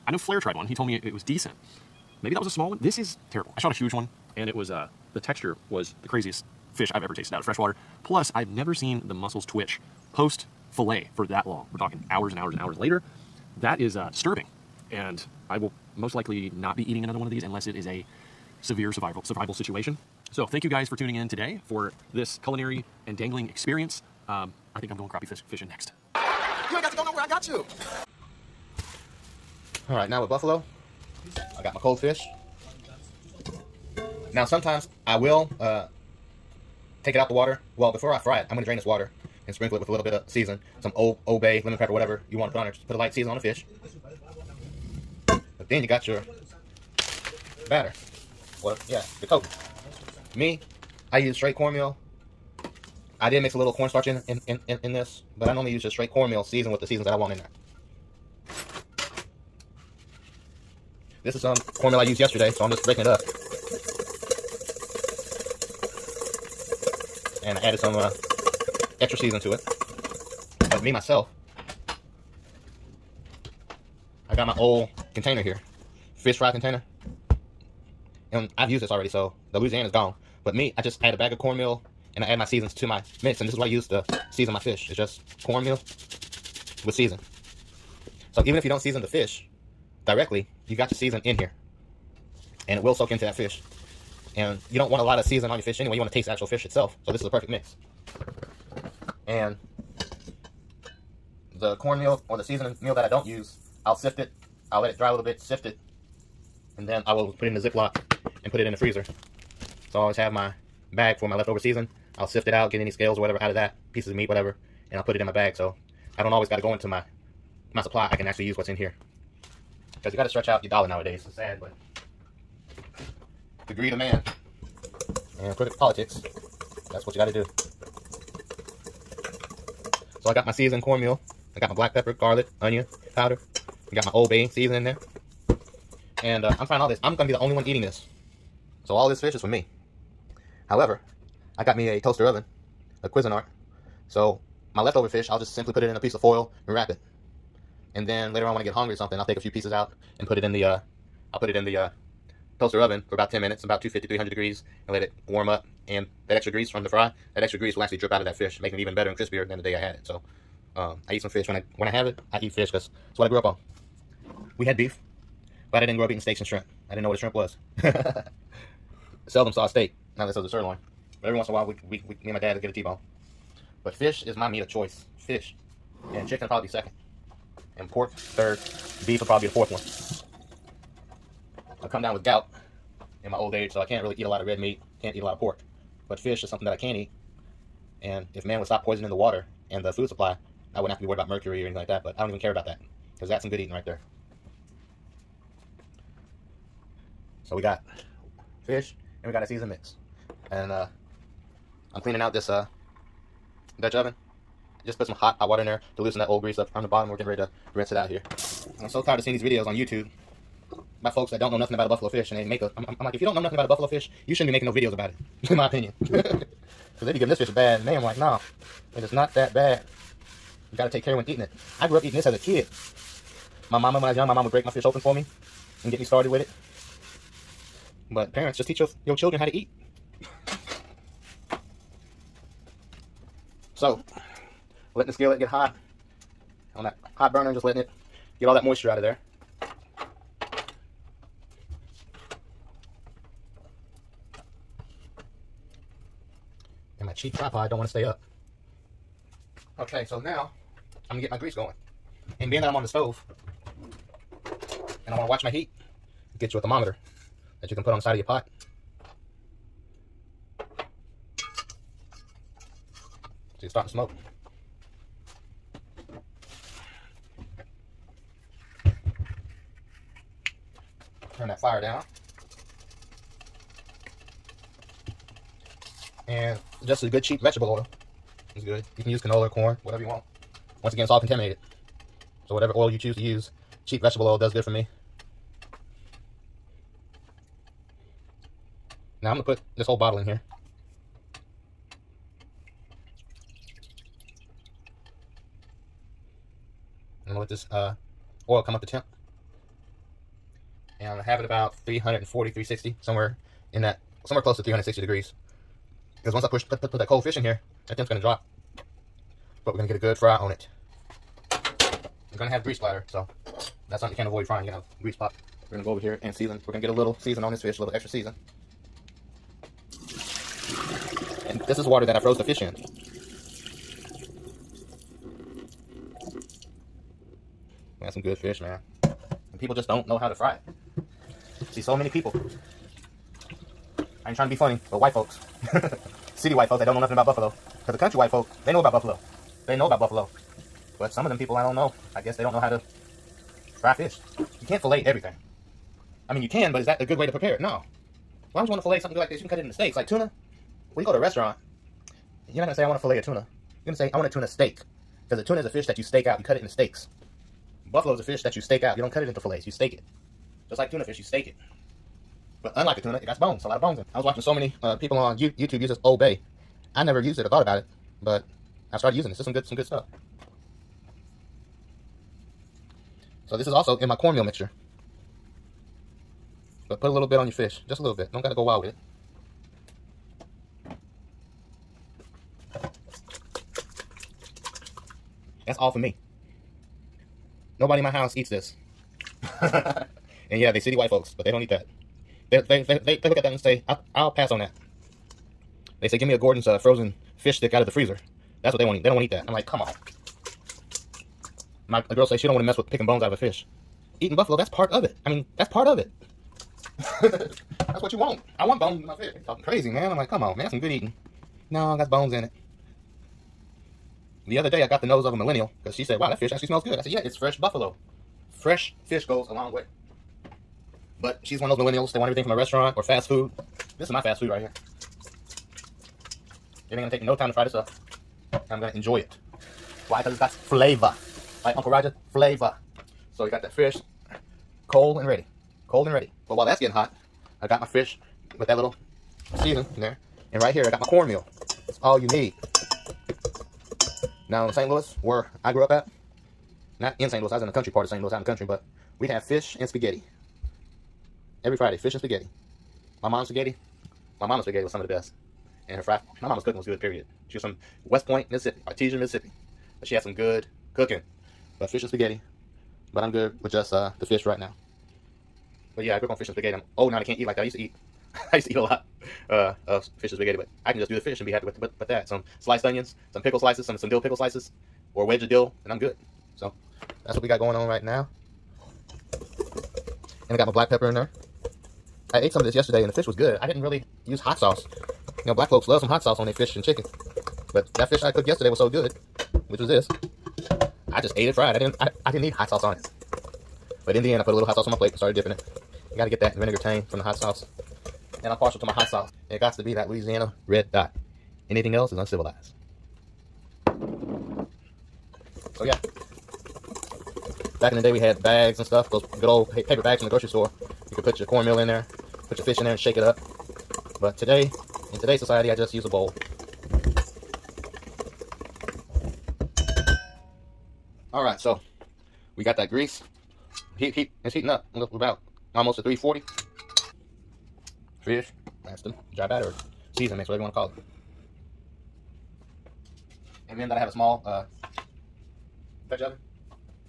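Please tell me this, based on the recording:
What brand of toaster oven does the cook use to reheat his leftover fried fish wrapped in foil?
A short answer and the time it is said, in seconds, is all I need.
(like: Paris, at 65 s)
Cuisinart, at 143 s.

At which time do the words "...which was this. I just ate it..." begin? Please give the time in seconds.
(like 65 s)
489 s.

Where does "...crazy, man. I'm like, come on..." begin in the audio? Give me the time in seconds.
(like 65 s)
409 s.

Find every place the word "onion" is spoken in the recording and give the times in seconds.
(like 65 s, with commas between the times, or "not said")
132 s, 472 s.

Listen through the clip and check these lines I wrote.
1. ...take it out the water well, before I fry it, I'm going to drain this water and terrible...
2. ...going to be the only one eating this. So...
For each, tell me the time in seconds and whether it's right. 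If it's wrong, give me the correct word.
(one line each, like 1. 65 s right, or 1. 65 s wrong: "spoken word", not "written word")
1. 37 s wrong: "sprinkle", not "terrible"
2. 137 s right.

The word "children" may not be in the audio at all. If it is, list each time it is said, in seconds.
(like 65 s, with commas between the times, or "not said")
229 s.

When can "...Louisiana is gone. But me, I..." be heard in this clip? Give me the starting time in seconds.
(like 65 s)
79 s.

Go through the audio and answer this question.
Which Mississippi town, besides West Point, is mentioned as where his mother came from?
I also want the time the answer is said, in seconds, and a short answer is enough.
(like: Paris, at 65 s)
Artesia, at 458 s.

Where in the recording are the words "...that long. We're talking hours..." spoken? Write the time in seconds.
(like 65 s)
11 s.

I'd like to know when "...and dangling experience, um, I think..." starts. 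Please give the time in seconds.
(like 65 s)
23 s.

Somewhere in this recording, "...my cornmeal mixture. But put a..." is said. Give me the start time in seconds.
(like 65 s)
374 s.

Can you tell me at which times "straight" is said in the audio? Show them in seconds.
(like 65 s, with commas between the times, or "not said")
51 s, 55 s.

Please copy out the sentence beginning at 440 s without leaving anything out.
And right here, I got my cornmeal.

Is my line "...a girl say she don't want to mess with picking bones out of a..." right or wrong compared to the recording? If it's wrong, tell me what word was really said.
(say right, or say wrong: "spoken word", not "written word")
right.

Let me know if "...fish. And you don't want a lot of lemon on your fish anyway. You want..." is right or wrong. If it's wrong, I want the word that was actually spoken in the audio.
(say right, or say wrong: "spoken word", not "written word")
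wrong: "season", not "lemon".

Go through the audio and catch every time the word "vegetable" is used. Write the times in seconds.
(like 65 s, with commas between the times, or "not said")
277 s, 284 s.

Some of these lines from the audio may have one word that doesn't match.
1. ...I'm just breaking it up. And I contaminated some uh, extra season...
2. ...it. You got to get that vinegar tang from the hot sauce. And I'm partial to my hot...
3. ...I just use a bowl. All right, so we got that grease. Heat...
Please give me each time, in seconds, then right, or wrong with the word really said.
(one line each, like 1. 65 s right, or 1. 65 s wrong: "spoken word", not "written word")
1. 62 s wrong: "added", not "contaminated"
2. 495 s right
3. 515 s right.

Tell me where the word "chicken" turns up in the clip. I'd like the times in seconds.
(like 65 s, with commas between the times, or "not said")
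176 s, 486 s.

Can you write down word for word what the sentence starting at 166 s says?
I didn't know what a shrimp was.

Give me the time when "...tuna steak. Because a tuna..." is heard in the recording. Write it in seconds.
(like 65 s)
354 s.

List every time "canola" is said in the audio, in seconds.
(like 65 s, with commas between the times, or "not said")
279 s.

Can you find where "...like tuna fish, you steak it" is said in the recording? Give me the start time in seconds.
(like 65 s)
360 s.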